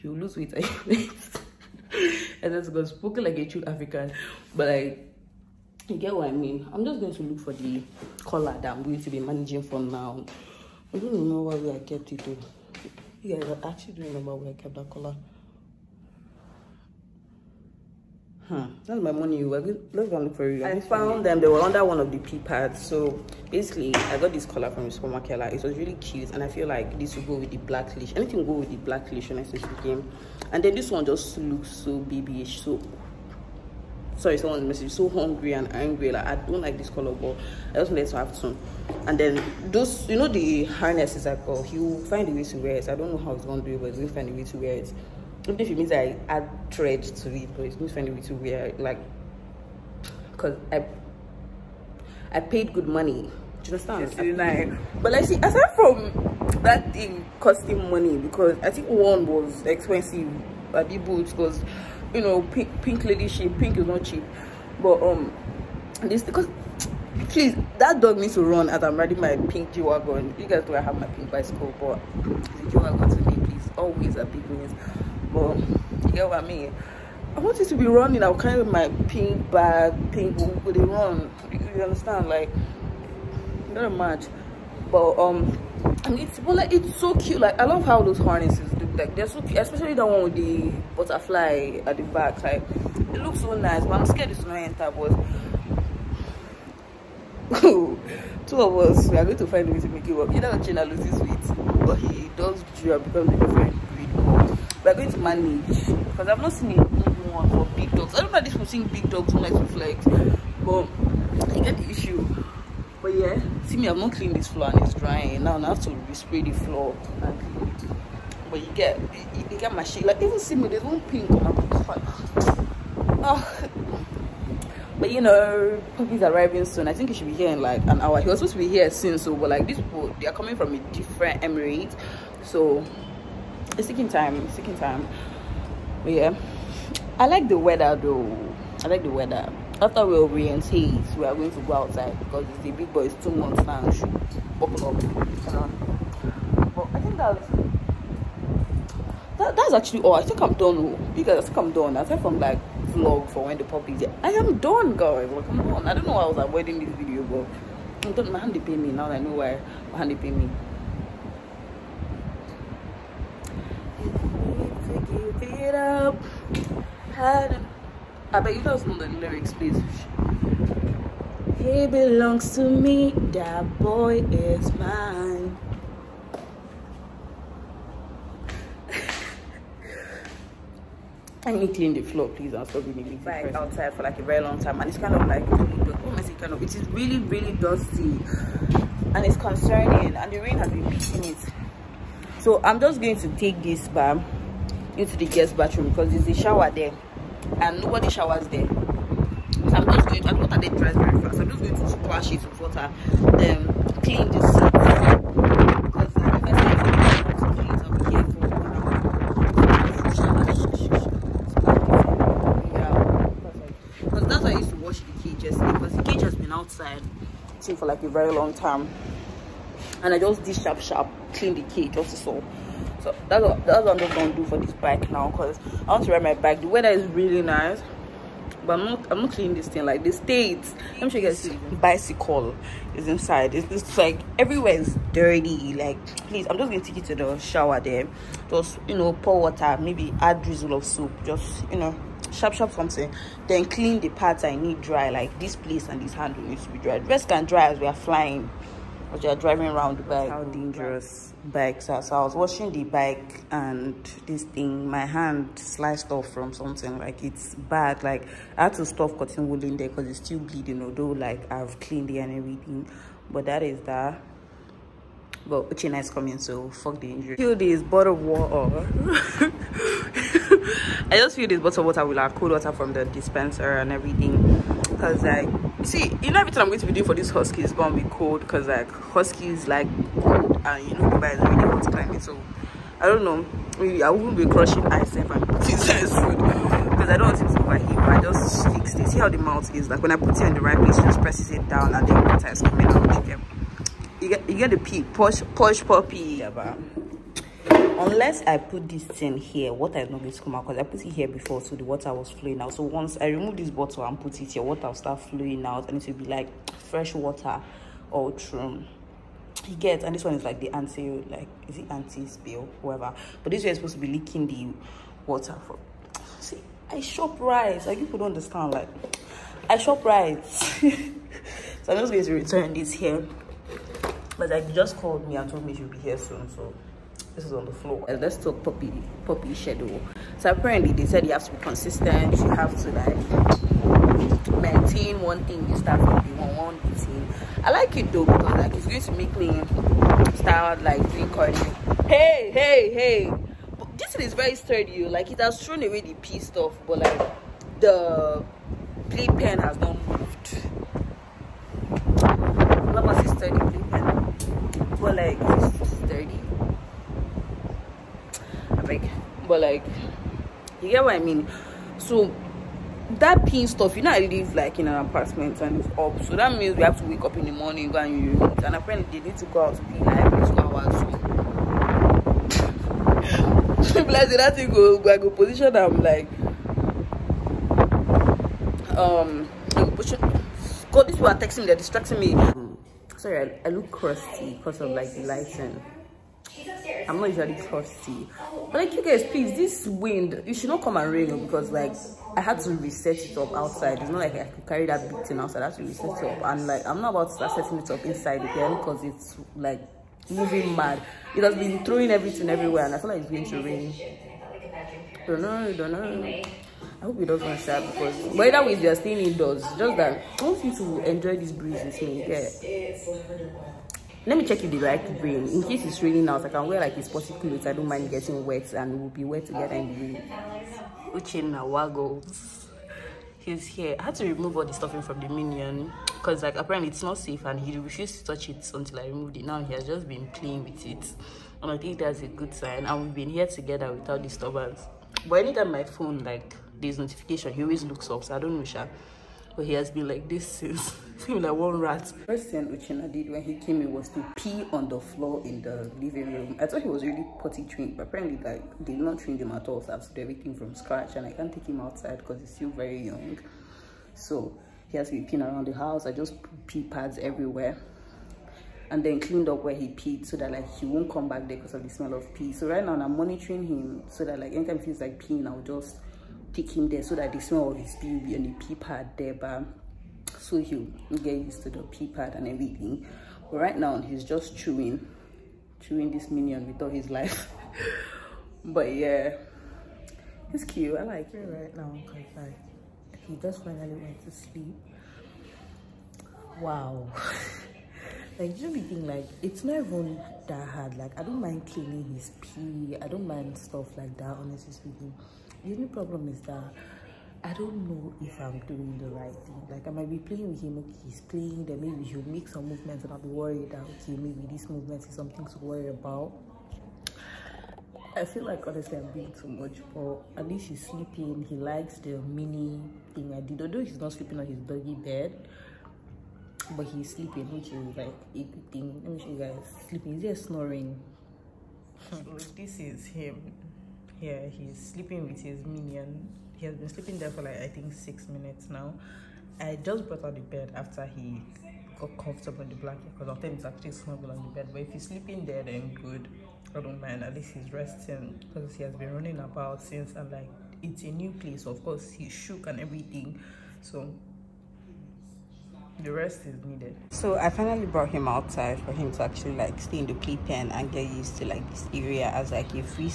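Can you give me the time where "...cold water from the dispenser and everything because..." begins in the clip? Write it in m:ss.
4:32.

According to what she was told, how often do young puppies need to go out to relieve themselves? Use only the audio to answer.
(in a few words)
Every two hours.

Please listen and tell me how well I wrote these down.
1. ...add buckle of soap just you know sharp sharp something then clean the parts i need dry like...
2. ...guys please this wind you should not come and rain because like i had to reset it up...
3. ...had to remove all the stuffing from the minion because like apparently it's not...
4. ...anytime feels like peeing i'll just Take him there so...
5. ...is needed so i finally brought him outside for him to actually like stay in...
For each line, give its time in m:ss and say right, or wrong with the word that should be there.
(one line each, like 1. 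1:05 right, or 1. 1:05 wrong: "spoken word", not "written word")
1. 4:00 wrong: "drizzle", not "buckle"
2. 6:29 right
3. 7:04 right
4. 7:44 right
5. 9:06 right.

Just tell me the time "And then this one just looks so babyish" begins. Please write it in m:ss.
0:30.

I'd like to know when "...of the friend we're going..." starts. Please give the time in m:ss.
1:43.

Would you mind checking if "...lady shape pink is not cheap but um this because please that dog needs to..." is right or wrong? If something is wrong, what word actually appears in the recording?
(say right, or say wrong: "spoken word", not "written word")
right.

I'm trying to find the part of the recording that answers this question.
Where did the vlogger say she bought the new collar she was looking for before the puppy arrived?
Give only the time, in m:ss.
0:24.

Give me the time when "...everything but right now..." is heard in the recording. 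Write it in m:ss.
7:52.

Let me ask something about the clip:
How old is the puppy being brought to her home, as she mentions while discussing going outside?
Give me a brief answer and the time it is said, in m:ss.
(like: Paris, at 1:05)
Two months, at 2:23.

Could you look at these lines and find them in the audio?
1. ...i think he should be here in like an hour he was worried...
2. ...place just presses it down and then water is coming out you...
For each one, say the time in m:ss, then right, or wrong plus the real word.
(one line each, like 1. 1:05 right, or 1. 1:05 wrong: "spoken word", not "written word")
1. 2:06 wrong: "supposed", not "worried"
2. 4:50 right.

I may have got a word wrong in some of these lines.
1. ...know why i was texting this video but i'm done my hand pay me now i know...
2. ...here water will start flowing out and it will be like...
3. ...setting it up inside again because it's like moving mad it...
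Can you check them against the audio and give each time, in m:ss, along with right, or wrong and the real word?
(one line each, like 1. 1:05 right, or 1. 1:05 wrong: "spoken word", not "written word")
1. 2:36 wrong: "avoiding", not "texting"
2. 5:04 right
3. 6:37 right.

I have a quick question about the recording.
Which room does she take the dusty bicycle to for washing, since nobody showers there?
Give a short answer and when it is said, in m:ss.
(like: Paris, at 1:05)
Guest bathroom, at 3:15.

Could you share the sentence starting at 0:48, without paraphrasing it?
like because I I paid good money.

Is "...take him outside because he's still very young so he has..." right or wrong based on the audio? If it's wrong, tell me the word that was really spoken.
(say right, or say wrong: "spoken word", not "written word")
right.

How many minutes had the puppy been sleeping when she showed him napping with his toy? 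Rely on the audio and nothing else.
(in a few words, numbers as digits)
6.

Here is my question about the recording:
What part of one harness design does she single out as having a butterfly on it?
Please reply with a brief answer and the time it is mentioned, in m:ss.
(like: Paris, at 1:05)
The back, at 1:31.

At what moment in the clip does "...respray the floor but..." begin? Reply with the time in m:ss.
1:56.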